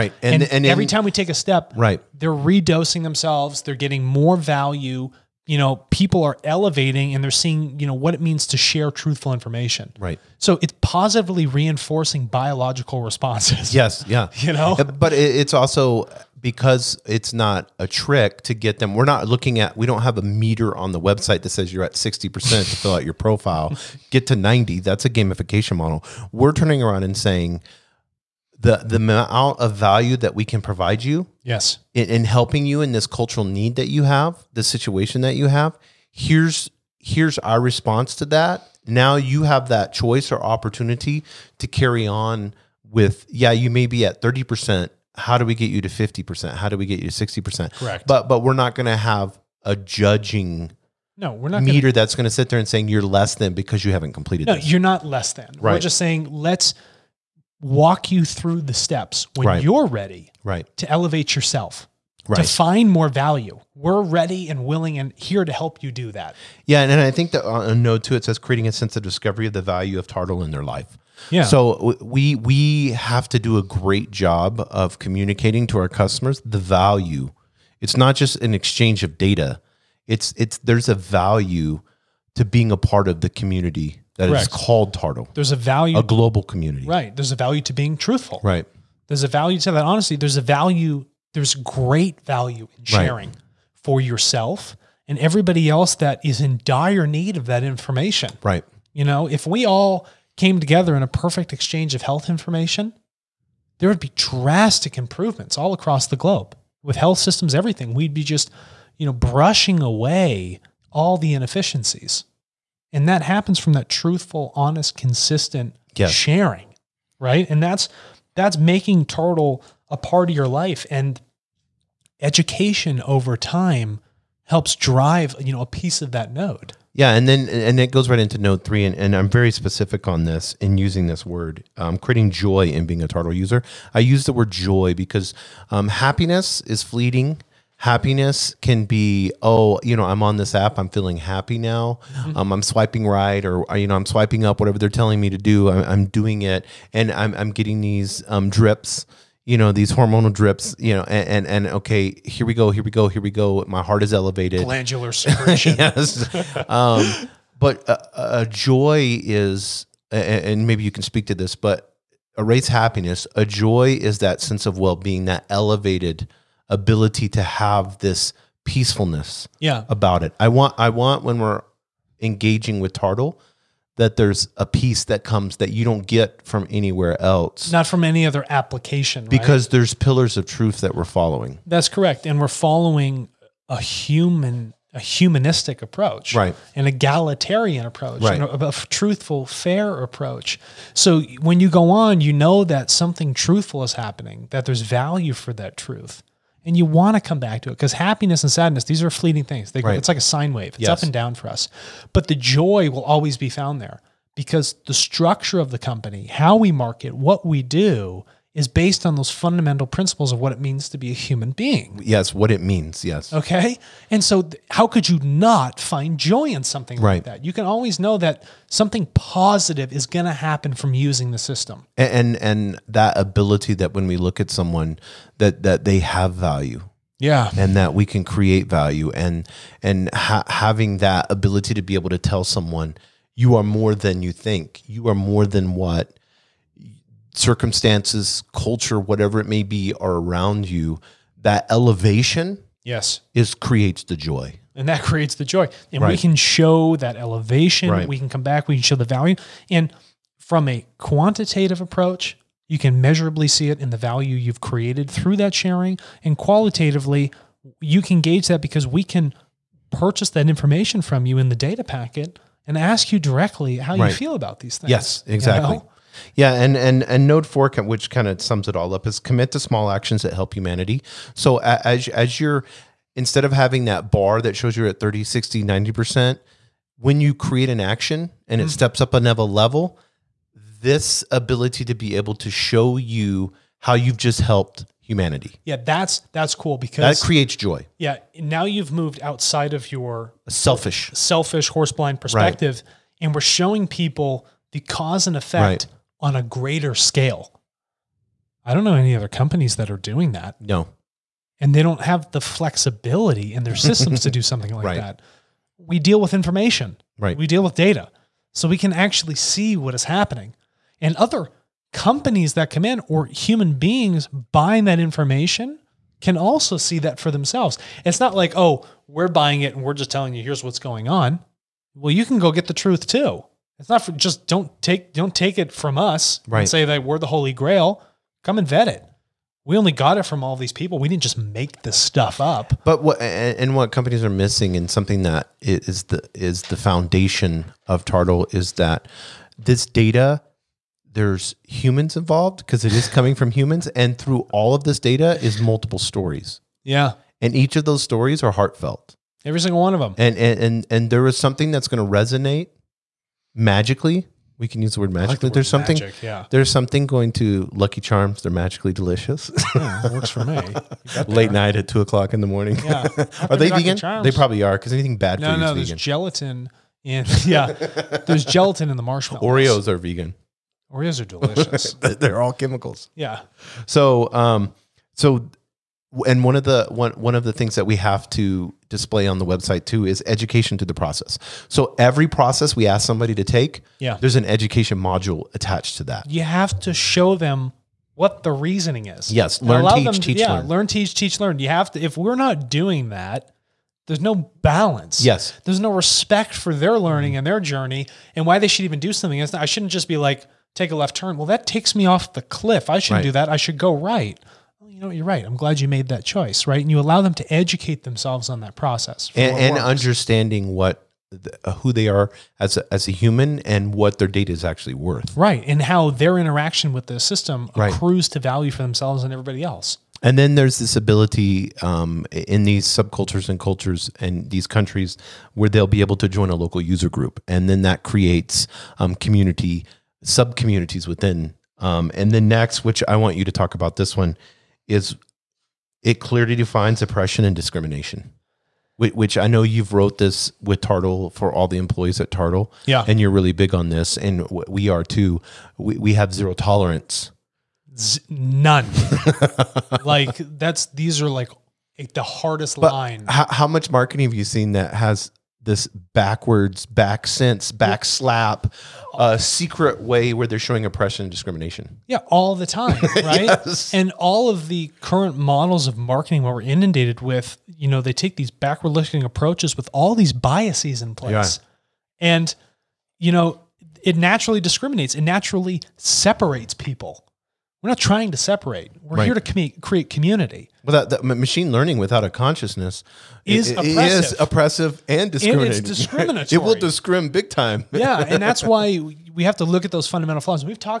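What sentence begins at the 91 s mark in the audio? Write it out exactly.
There's great value in sharing right.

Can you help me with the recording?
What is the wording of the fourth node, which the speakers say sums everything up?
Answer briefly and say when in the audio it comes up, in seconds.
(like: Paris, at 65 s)
Commit to small actions that help humanity, at 269 s.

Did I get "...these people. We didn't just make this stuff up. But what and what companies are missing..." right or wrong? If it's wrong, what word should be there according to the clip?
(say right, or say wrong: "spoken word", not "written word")
right.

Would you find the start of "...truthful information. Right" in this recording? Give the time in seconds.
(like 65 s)
8 s.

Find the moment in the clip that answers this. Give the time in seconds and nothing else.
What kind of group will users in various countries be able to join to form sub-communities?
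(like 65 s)
426 s.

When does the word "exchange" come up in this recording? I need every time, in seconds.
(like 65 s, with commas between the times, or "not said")
78 s, 101 s.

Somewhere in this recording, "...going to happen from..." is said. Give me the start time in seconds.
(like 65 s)
220 s.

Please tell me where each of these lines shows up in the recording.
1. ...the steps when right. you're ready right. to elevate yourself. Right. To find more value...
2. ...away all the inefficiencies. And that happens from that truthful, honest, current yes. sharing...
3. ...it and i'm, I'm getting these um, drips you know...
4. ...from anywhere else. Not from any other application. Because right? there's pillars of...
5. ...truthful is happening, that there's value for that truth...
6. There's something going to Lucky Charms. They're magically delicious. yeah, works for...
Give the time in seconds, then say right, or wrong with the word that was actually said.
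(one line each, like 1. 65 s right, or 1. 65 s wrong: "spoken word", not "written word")
1. 58 s right
2. 109 s wrong: "consistent", not "current"
3. 146 s right
4. 176 s right
5. 193 s right
6. 356 s right.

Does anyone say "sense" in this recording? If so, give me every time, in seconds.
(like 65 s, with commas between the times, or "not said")
68 s, 164 s, 457 s.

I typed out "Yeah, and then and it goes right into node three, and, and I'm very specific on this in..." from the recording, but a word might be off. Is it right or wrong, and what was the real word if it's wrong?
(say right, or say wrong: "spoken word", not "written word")
right.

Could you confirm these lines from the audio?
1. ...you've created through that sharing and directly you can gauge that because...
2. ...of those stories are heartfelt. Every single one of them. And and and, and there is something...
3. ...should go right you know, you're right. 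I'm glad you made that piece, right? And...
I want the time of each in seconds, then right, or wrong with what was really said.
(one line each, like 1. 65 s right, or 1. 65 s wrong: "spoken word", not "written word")
1. 254 s wrong: "qualitatively", not "directly"
2. 347 s right
3. 403 s wrong: "choice", not "piece".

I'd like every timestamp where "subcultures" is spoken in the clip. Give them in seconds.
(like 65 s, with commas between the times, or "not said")
422 s.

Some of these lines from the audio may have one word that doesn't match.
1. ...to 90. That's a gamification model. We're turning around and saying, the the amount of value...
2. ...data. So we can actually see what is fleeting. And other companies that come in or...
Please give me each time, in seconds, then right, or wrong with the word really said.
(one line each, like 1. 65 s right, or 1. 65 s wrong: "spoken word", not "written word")
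1. 24 s right
2. 307 s wrong: "happening", not "fleeting".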